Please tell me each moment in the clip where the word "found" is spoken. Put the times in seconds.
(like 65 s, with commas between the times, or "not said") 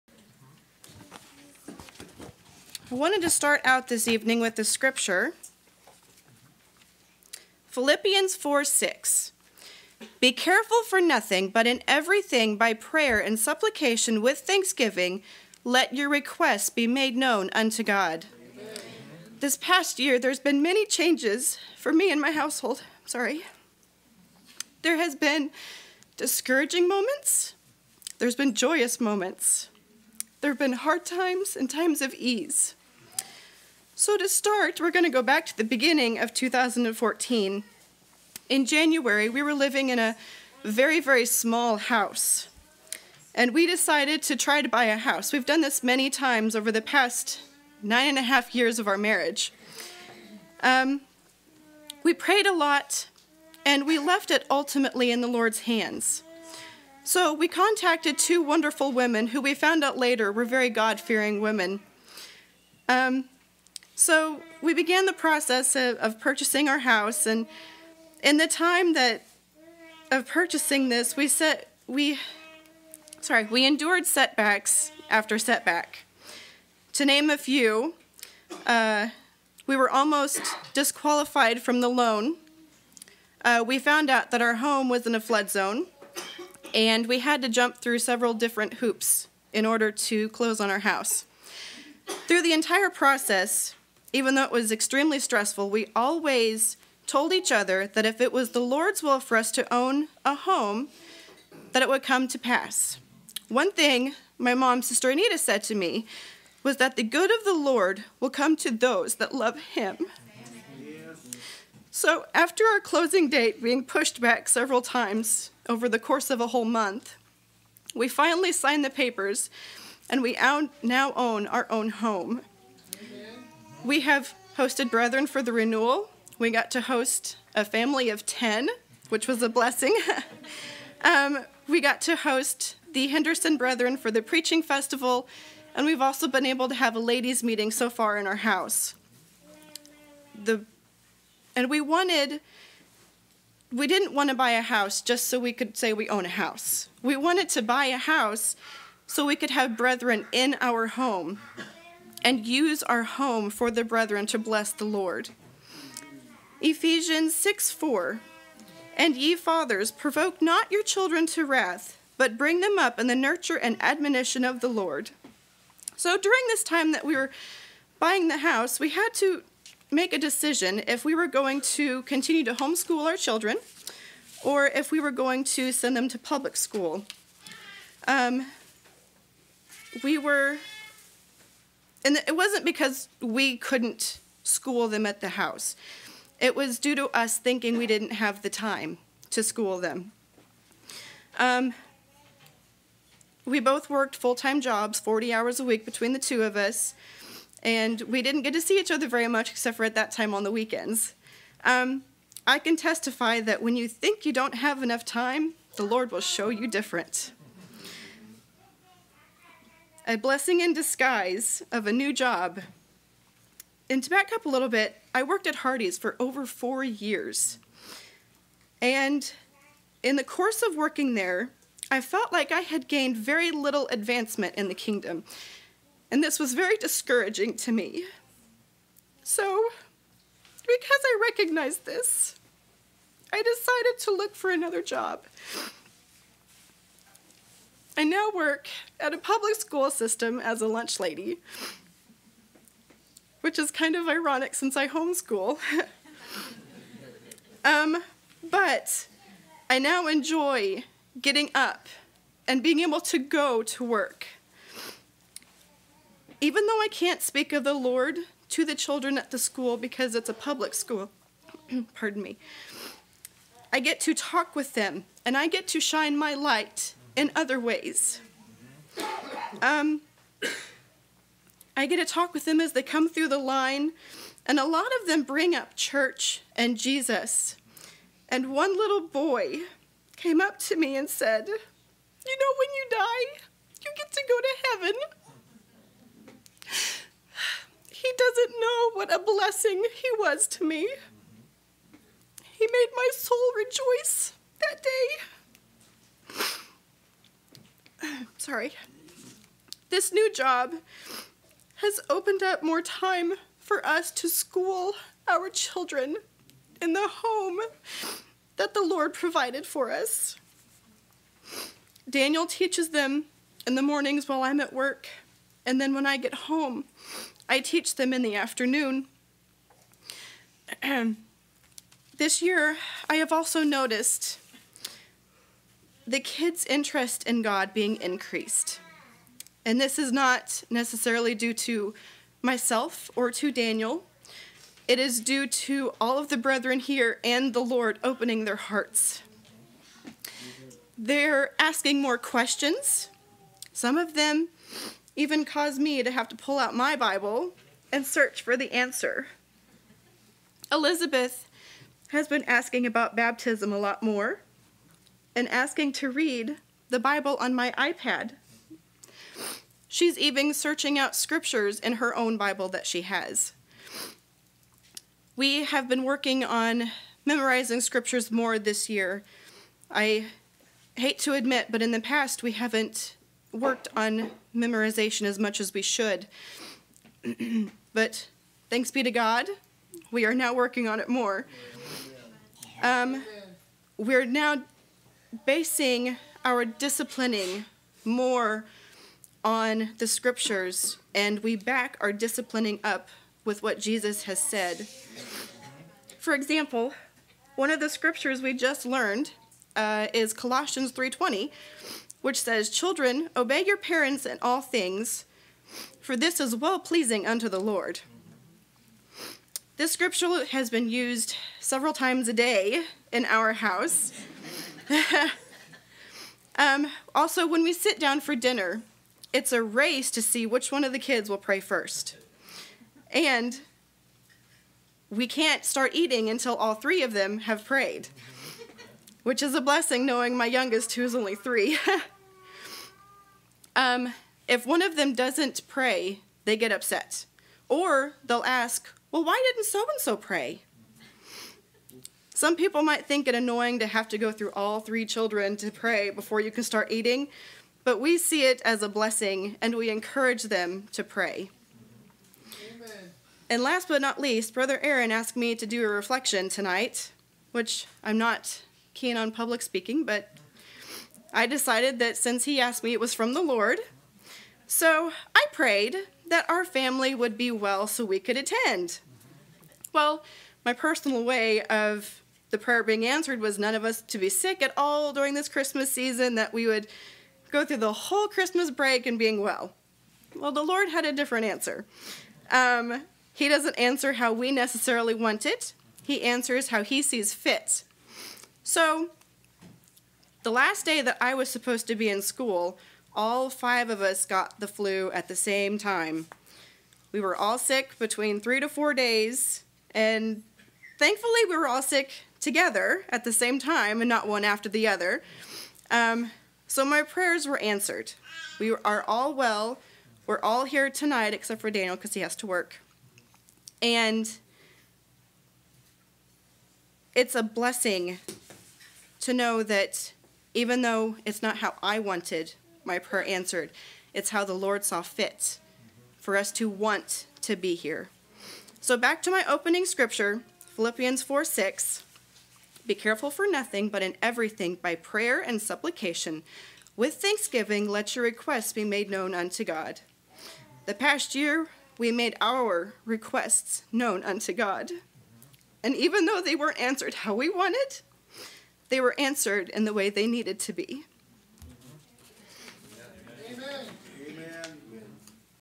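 59 s, 83 s.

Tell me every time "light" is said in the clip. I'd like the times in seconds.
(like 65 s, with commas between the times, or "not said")
266 s.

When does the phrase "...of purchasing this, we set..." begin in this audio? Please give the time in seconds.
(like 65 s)
70 s.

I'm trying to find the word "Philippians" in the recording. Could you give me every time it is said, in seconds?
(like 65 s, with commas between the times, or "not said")
7 s, 530 s.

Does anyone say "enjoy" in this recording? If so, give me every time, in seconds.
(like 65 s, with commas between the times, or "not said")
250 s.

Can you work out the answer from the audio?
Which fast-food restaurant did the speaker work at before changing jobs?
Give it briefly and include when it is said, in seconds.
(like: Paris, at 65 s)
Hardee's, at 215 s.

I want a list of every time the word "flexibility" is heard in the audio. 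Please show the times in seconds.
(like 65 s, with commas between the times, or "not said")
not said.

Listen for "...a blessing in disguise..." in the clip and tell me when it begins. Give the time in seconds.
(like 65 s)
210 s.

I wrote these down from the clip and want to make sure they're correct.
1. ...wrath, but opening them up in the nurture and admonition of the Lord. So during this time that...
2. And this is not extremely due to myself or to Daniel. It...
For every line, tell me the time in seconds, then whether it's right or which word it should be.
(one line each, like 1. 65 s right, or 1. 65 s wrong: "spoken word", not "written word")
1. 161 s wrong: "bring", not "opening"
2. 329 s wrong: "necessarily", not "extremely".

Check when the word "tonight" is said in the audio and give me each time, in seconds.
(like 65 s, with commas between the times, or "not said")
456 s, 510 s.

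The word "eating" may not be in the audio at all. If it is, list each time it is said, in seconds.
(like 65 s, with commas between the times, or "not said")
425 s, 446 s.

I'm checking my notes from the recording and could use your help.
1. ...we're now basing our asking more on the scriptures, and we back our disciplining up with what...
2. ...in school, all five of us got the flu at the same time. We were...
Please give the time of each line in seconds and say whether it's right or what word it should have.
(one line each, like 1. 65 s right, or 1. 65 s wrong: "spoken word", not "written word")
1. 383 s wrong: "disciplining", not "asking"
2. 492 s right.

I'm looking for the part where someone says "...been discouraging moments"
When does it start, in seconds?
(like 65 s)
25 s.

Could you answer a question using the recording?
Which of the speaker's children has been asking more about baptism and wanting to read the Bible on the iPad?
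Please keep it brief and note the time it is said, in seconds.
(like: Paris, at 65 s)
Elizabeth, at 350 s.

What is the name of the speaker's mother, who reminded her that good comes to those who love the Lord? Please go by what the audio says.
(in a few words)
Sister Anita.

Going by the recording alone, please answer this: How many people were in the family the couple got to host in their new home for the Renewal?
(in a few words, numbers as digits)
10.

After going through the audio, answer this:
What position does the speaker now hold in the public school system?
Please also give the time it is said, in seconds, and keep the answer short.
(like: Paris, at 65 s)
Lunch lady, at 240 s.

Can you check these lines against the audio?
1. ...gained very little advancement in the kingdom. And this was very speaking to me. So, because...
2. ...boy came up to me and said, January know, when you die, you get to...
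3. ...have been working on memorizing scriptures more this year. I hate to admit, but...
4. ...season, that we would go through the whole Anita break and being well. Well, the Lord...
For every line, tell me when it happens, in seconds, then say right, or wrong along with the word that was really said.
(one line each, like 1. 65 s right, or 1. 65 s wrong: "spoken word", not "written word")
1. 222 s wrong: "discouraging", not "speaking"
2. 279 s wrong: "You", not "January"
3. 365 s right
4. 475 s wrong: "Christmas", not "Anita".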